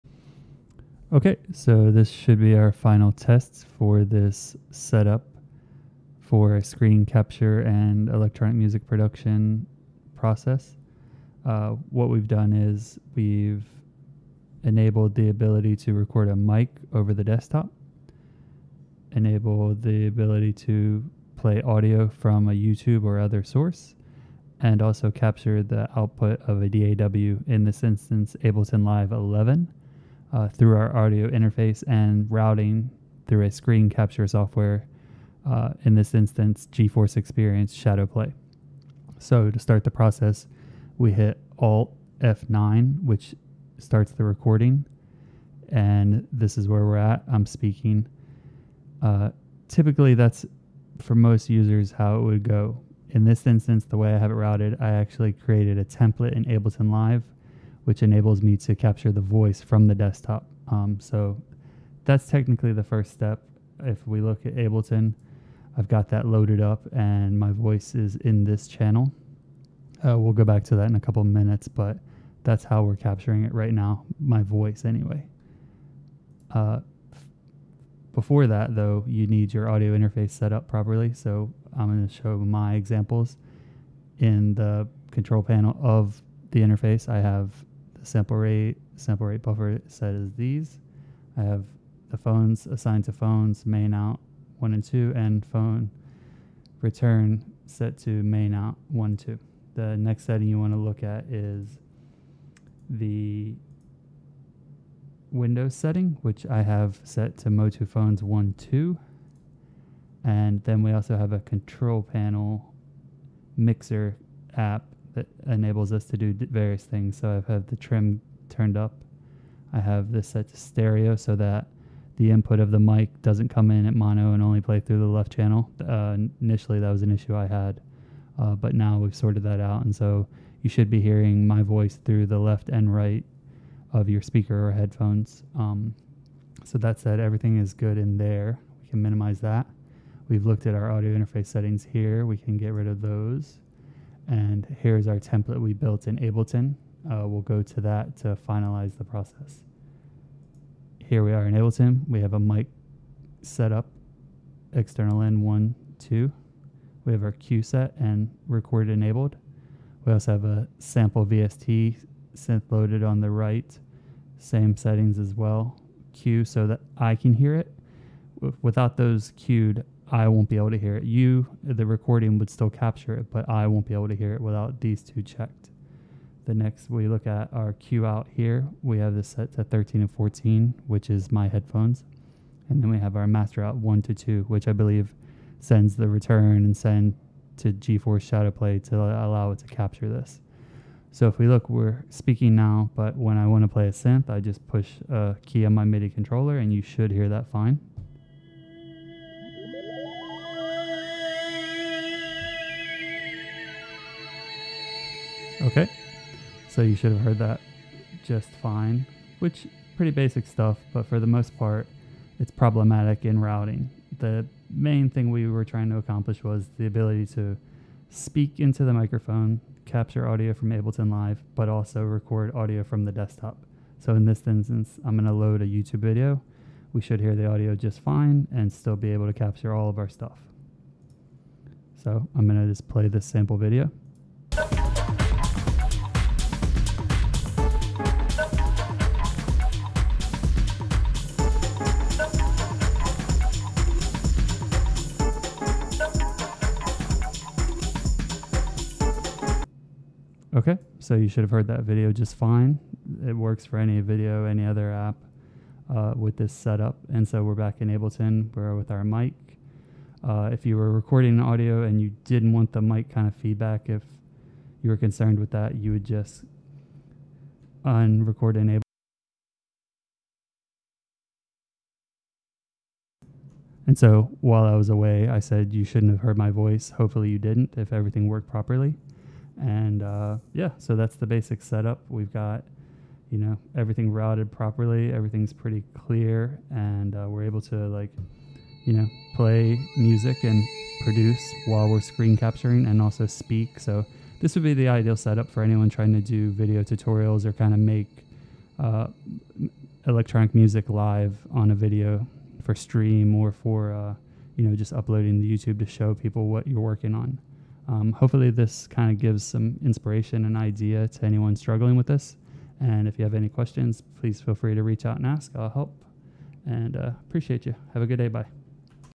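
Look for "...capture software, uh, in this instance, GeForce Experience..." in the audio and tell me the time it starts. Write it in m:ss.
0:33.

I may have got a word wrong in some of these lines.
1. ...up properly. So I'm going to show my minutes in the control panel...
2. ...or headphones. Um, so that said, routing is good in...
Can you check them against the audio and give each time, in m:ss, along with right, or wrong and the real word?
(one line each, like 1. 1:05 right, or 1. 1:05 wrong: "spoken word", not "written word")
1. 1:20 wrong: "examples", not "minutes"
2. 2:14 wrong: "everything", not "routing".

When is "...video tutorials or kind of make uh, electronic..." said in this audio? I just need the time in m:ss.
4:56.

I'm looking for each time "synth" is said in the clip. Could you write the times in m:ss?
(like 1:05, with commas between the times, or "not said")
2:42, 3:13.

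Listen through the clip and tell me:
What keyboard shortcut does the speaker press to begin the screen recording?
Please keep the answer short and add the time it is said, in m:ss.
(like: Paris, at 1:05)
Alt F9, at 0:41.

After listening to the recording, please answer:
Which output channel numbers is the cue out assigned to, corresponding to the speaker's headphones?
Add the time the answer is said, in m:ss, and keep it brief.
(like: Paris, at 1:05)
13 and 14, at 2:59.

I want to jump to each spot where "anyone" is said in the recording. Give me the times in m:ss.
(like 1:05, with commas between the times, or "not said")
4:55, 5:11.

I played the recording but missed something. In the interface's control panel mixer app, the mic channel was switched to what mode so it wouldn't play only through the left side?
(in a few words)
stereo.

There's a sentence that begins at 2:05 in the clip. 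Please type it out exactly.
Uh, initially, that was an issue I had, uh, but now we've sorted that out.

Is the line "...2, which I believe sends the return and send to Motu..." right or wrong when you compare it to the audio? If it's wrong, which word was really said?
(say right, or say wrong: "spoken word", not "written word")
wrong: "GeForce", not "Motu".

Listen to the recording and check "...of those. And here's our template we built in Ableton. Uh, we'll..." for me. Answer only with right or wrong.
right.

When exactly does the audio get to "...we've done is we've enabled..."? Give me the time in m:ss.
0:12.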